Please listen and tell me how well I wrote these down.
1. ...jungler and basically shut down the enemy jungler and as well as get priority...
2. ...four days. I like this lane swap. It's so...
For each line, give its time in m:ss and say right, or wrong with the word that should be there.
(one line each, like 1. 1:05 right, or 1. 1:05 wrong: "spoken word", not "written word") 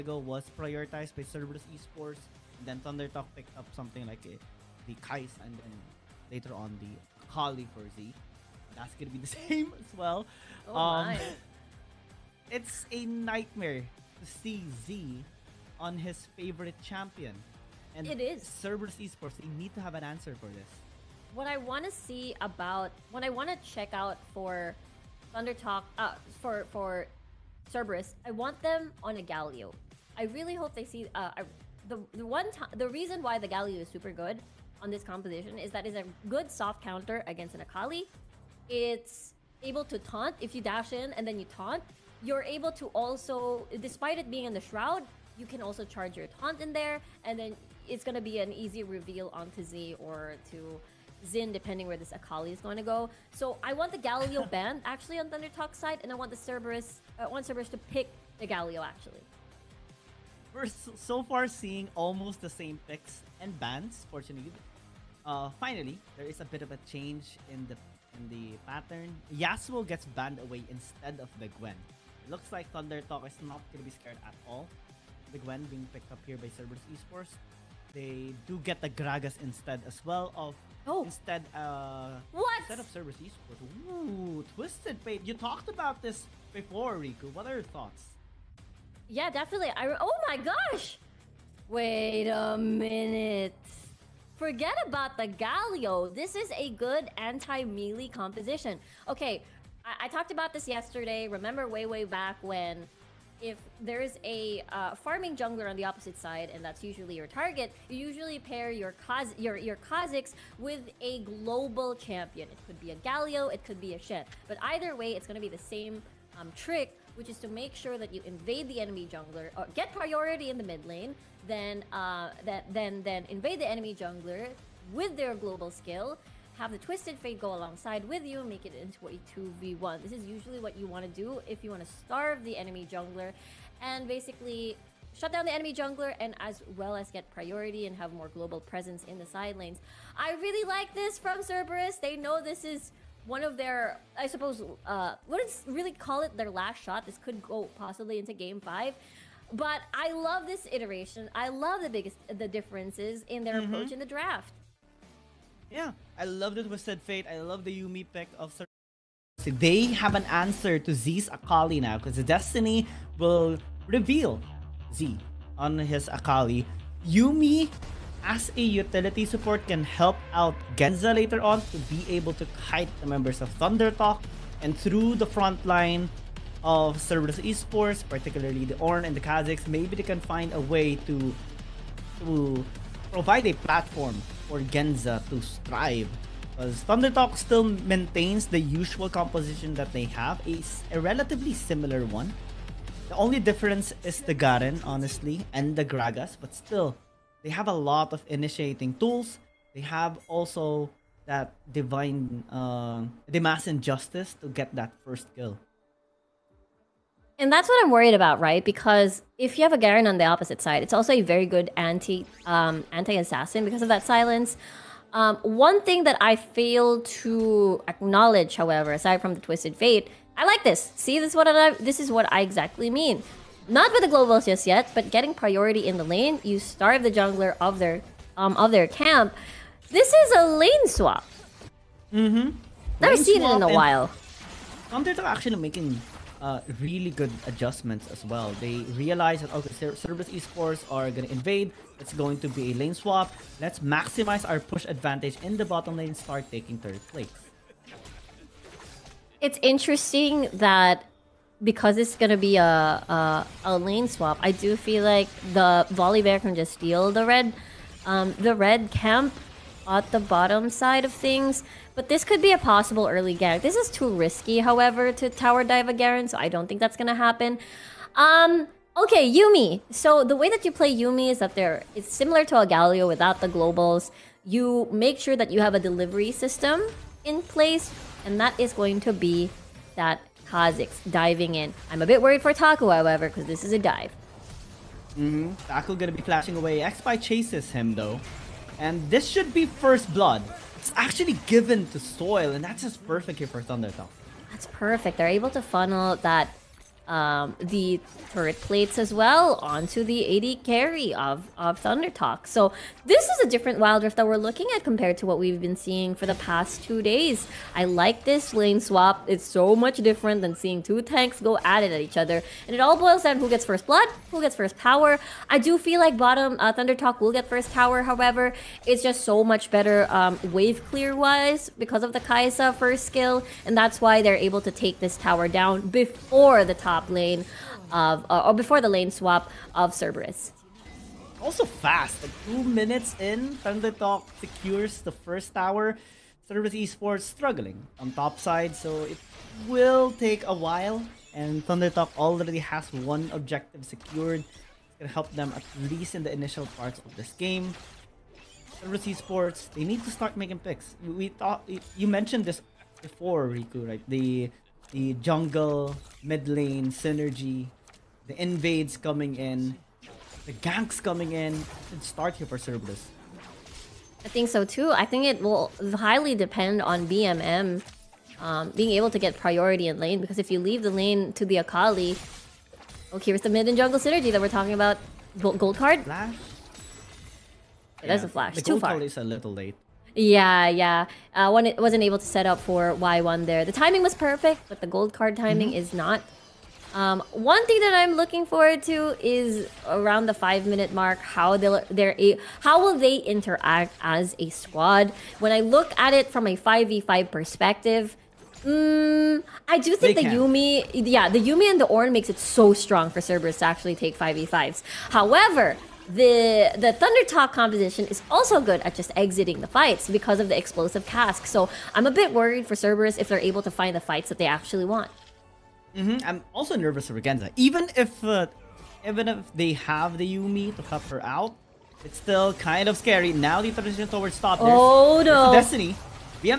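1. 2:12 right
2. 5:06 wrong: "two", not "four".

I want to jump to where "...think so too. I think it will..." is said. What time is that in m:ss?
6:04.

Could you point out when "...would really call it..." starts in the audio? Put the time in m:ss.
2:25.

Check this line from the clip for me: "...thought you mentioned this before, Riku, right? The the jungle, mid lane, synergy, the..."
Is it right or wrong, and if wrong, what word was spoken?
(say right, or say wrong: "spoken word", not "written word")
right.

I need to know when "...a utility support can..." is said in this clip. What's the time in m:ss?
2:48.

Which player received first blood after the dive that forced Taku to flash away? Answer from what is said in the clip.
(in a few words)
Soil.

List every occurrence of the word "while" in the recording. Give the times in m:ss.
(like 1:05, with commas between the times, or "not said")
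3:53, 5:40.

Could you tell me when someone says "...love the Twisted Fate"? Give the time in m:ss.
2:36.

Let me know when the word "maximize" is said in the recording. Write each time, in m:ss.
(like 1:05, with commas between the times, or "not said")
4:03.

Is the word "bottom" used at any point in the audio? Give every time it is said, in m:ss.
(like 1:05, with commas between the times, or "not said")
4:05, 4:20, 5:16.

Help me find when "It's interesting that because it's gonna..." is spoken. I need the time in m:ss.
4:09.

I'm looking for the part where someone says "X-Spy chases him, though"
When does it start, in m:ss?
4:46.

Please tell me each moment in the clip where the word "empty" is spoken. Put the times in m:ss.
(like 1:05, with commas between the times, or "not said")
not said.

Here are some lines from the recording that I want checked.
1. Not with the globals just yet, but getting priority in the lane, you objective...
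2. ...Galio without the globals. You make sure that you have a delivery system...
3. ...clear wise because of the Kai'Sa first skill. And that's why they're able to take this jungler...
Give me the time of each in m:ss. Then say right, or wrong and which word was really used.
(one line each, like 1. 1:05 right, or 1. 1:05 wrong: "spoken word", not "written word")
1. 3:43 wrong: "starve", not "objective"
2. 4:32 right
3. 5:20 wrong: "tower", not "jungler".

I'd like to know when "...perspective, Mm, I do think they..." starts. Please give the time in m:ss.
6:37.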